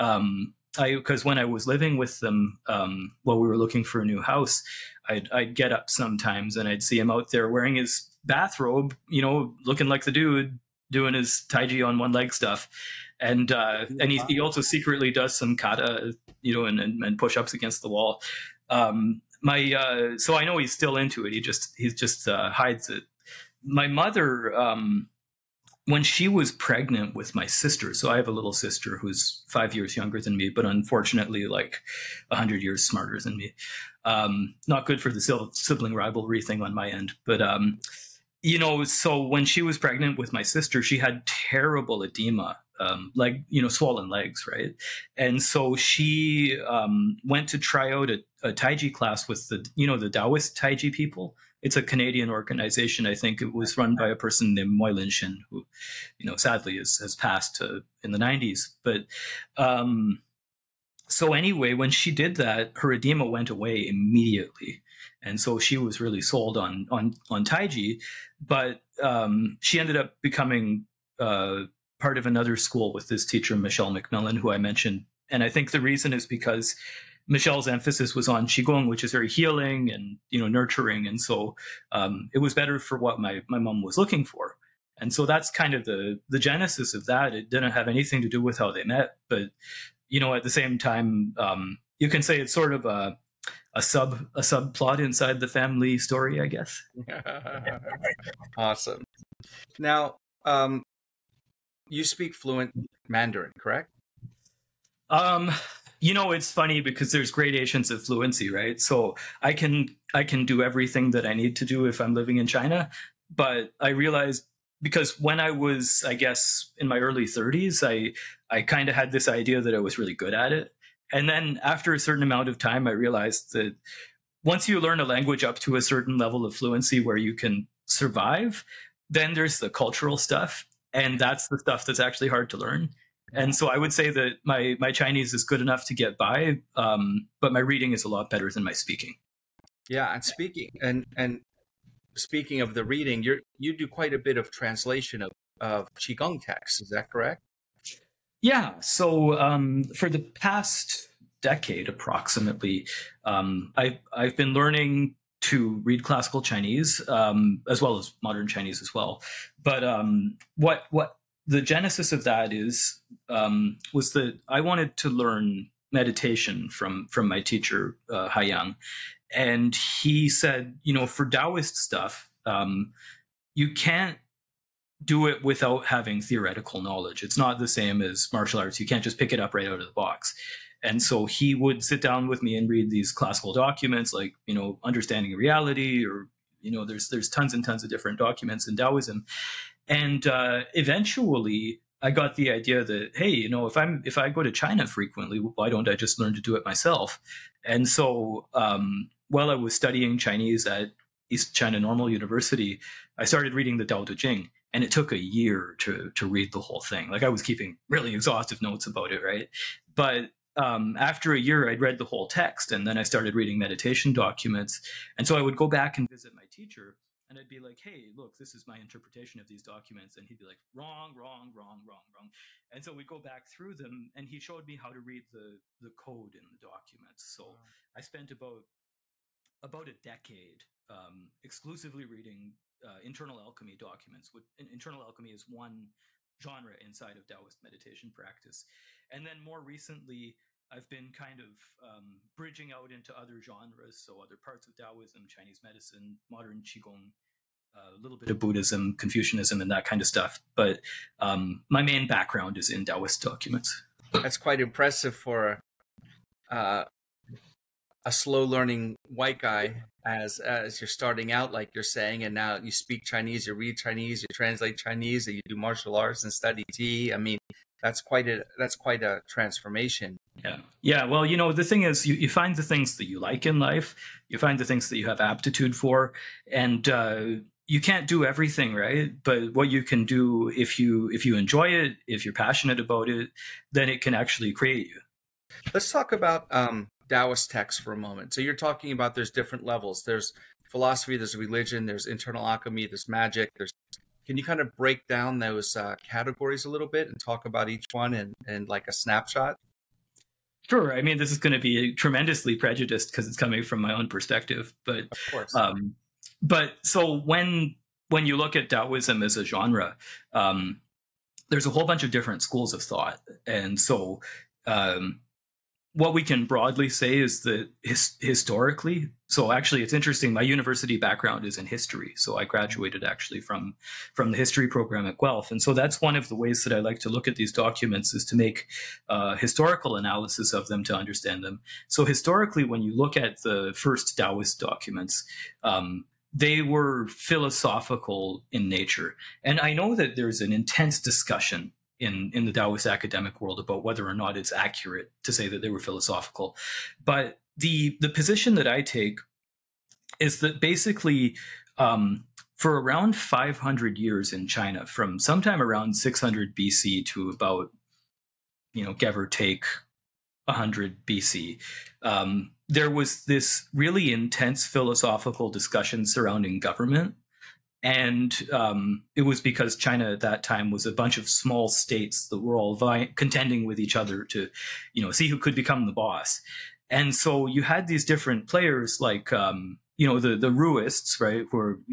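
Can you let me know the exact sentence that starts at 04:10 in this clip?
But um, my main background is in Taoist documents.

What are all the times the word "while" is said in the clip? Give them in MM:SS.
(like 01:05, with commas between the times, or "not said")
00:03, 03:19.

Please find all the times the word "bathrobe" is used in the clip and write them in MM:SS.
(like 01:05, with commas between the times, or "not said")
00:08.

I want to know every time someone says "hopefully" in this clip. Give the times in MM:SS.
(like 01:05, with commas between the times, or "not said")
not said.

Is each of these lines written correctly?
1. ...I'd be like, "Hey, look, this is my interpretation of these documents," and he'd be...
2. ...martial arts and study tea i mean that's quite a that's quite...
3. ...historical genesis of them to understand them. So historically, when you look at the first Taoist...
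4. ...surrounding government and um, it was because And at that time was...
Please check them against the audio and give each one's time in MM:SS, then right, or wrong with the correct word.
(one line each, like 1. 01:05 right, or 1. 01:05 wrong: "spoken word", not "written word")
1. 03:37 right
2. 04:25 right
3. 05:29 wrong: "analysis", not "genesis"
4. 06:06 wrong: "China", not "And".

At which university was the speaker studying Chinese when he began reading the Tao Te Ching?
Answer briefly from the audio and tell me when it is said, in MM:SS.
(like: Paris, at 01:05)
East China Normal University, at 03:21.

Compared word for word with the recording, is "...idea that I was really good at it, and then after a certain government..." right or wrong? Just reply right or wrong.
wrong.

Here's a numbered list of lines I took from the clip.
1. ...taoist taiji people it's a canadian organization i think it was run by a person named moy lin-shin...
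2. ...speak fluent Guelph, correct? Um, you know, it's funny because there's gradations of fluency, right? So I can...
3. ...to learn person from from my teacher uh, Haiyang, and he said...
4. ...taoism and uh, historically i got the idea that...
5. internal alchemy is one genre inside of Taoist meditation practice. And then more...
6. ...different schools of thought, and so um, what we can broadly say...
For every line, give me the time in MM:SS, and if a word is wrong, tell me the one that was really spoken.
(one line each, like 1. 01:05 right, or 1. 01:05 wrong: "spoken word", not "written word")
1. 00:50 right
2. 01:42 wrong: "Mandarin", not "Guelph"
3. 02:44 wrong: "meditation", not "person"
4. 03:08 wrong: "eventually", not "historically"
5. 03:54 right
6. 05:12 right.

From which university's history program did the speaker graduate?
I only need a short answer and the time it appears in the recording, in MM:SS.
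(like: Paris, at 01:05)
Guelph, at 05:25.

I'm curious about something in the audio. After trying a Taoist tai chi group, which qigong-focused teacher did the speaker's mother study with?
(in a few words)
Michelle McMillan.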